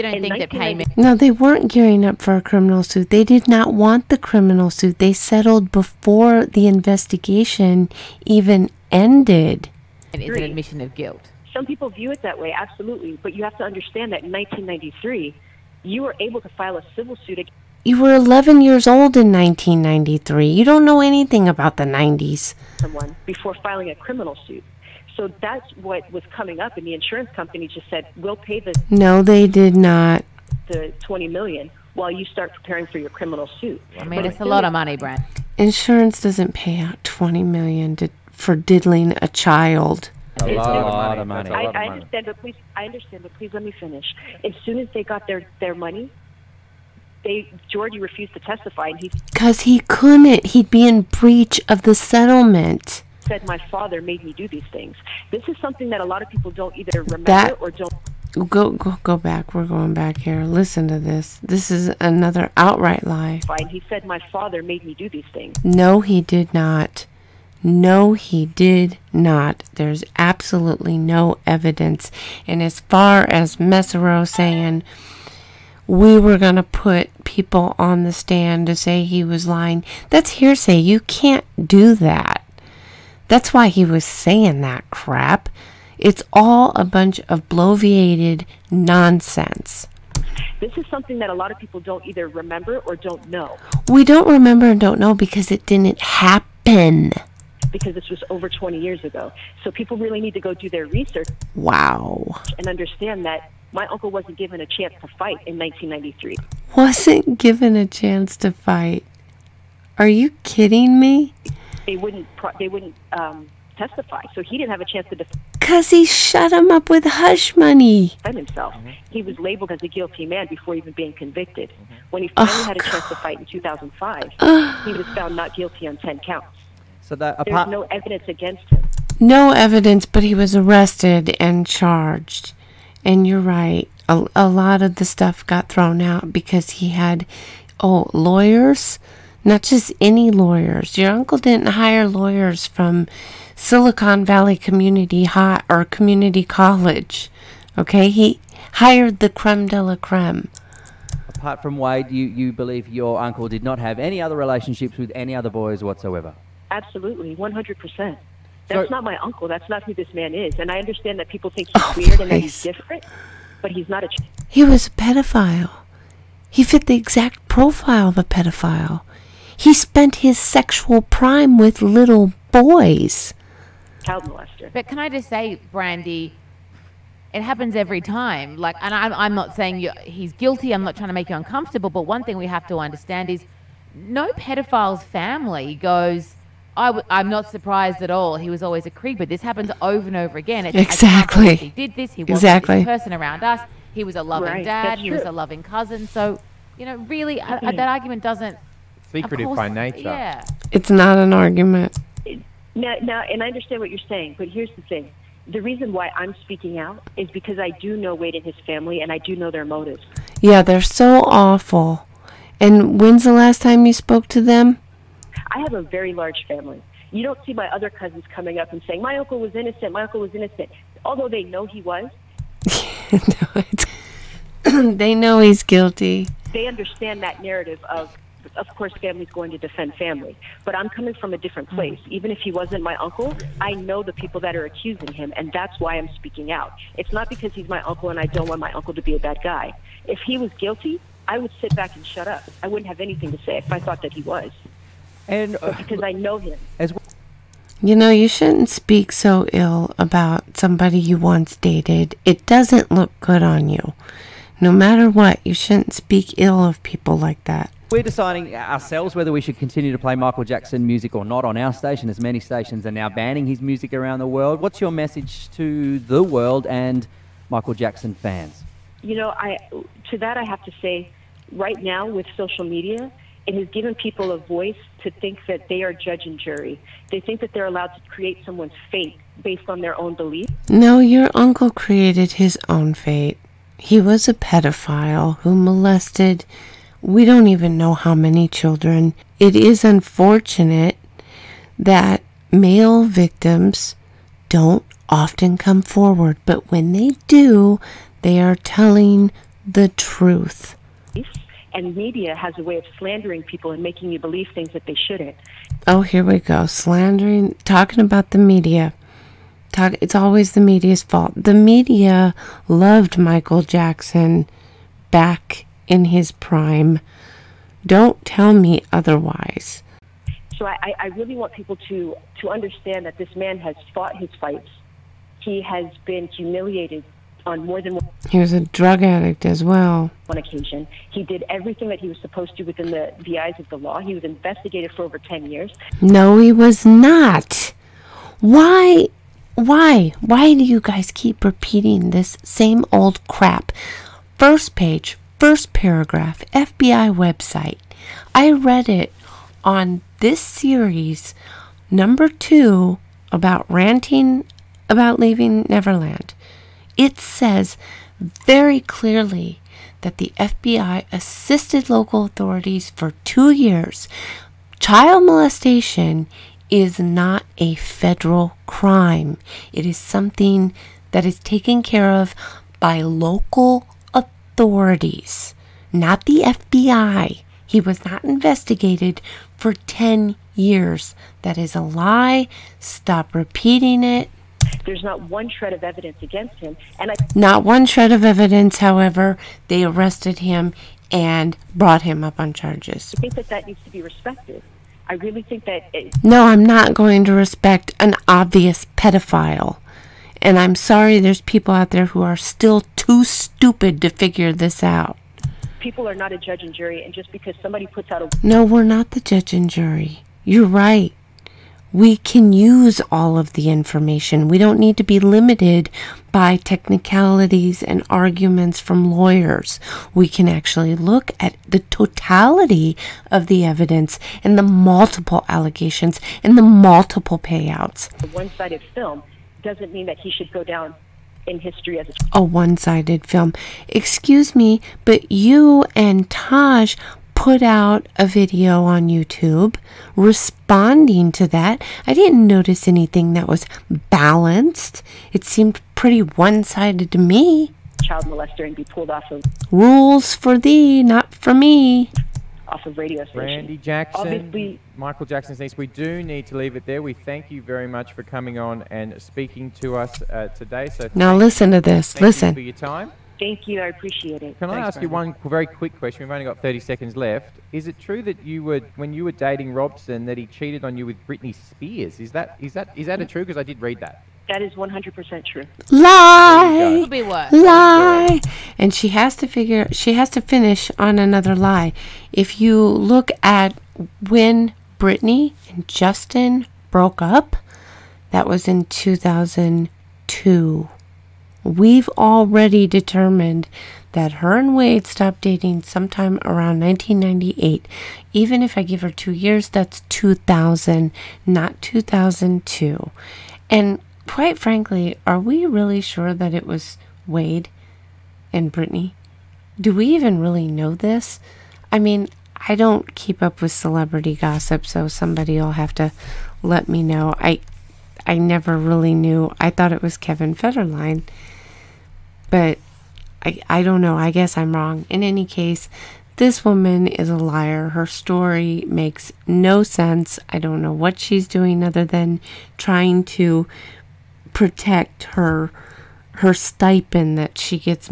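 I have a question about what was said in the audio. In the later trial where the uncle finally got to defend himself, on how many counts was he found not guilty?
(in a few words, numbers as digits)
10 counts.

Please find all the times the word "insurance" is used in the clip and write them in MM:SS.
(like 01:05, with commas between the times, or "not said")
00:26, 00:35.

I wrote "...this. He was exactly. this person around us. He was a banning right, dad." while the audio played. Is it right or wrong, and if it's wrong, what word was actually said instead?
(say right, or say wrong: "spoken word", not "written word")
wrong: "loving", not "banning".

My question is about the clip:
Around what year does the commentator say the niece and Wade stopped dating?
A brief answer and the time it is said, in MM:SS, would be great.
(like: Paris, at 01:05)
1998, at 08:16.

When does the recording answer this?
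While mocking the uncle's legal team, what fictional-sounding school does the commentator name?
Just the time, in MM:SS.
02:23.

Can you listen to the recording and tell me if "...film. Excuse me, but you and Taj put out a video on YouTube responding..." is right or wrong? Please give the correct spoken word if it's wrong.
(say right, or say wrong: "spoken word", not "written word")
right.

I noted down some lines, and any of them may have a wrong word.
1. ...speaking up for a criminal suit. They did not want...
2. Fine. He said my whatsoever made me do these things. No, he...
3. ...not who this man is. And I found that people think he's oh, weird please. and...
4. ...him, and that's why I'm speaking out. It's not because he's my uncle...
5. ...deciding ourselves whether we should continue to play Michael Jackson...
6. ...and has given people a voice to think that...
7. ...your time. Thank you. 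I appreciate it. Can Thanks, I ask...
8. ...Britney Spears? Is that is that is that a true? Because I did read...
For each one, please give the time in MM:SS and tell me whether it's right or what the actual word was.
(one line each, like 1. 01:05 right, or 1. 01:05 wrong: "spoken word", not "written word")
1. 00:01 wrong: "gearing", not "speaking"
2. 01:03 wrong: "father", not "whatsoever"
3. 02:39 wrong: "understand", not "found"
4. 03:55 right
5. 04:18 right
6. 04:33 right
7. 07:42 right
8. 07:51 right.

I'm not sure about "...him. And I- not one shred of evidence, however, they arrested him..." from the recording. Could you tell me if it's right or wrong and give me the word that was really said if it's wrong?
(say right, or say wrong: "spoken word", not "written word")
right.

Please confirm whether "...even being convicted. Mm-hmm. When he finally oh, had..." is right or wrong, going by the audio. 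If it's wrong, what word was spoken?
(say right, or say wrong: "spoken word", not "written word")
right.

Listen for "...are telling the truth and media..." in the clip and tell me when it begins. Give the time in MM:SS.
04:58.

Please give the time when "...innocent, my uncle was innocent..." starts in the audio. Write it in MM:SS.
03:39.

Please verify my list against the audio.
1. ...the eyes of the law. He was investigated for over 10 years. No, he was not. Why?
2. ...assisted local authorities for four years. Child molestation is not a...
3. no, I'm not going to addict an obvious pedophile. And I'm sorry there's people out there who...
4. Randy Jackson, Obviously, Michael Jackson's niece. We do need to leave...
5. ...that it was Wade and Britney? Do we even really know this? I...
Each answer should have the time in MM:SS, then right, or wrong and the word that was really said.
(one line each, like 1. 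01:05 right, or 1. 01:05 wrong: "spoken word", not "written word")
1. 05:33 right
2. 06:01 wrong: "two", not "four"
3. 06:36 wrong: "respect", not "addict"
4. 07:33 right
5. 08:26 right.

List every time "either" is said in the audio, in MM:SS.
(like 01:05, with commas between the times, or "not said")
00:56, 01:32.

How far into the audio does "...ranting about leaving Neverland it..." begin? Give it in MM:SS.
05:53.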